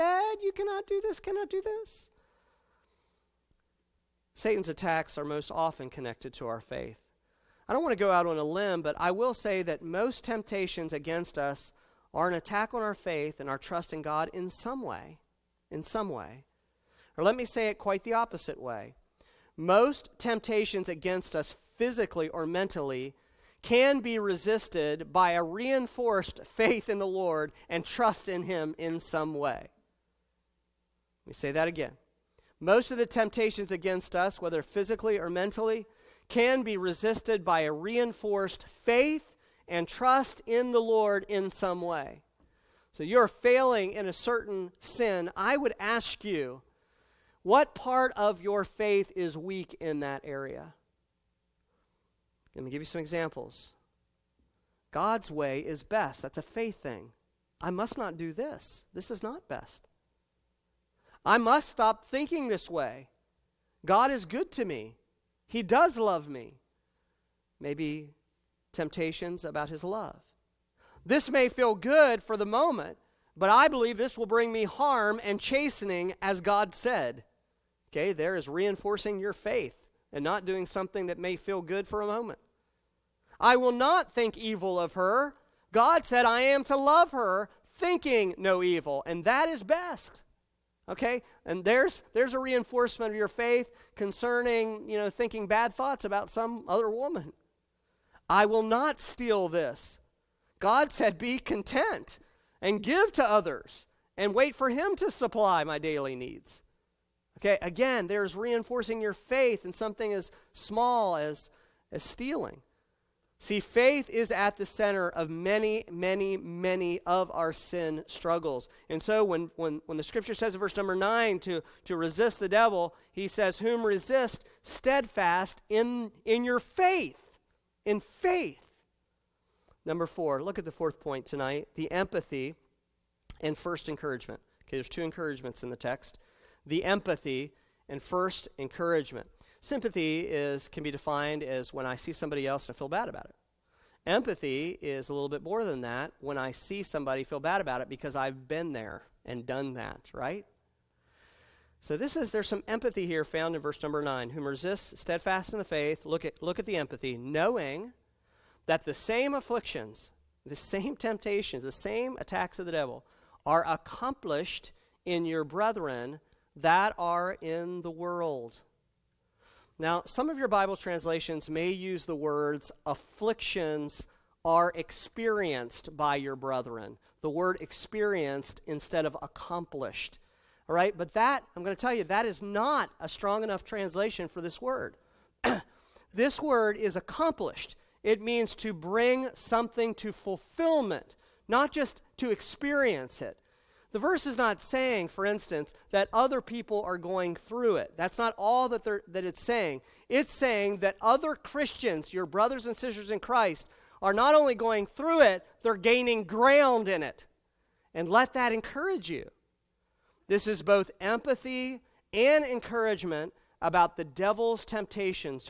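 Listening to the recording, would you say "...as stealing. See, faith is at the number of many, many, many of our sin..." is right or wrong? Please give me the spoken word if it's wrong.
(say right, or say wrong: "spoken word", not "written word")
wrong: "center", not "number".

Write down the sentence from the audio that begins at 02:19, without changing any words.
Sympathy is, can be defined as when I see somebody else and I feel bad about it.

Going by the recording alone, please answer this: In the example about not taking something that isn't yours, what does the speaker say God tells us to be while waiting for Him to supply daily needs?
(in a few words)
Content.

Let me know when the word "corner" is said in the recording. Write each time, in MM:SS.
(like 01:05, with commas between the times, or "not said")
not said.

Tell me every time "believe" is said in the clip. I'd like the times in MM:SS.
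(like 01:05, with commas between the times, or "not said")
01:13.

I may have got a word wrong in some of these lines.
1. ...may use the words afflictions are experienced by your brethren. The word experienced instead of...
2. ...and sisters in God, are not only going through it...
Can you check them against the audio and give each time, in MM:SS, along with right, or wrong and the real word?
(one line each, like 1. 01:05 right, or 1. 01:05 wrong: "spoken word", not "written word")
1. 02:51 right
2. 03:22 wrong: "Christ", not "God".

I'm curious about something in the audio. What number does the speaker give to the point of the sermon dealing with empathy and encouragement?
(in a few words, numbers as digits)
4.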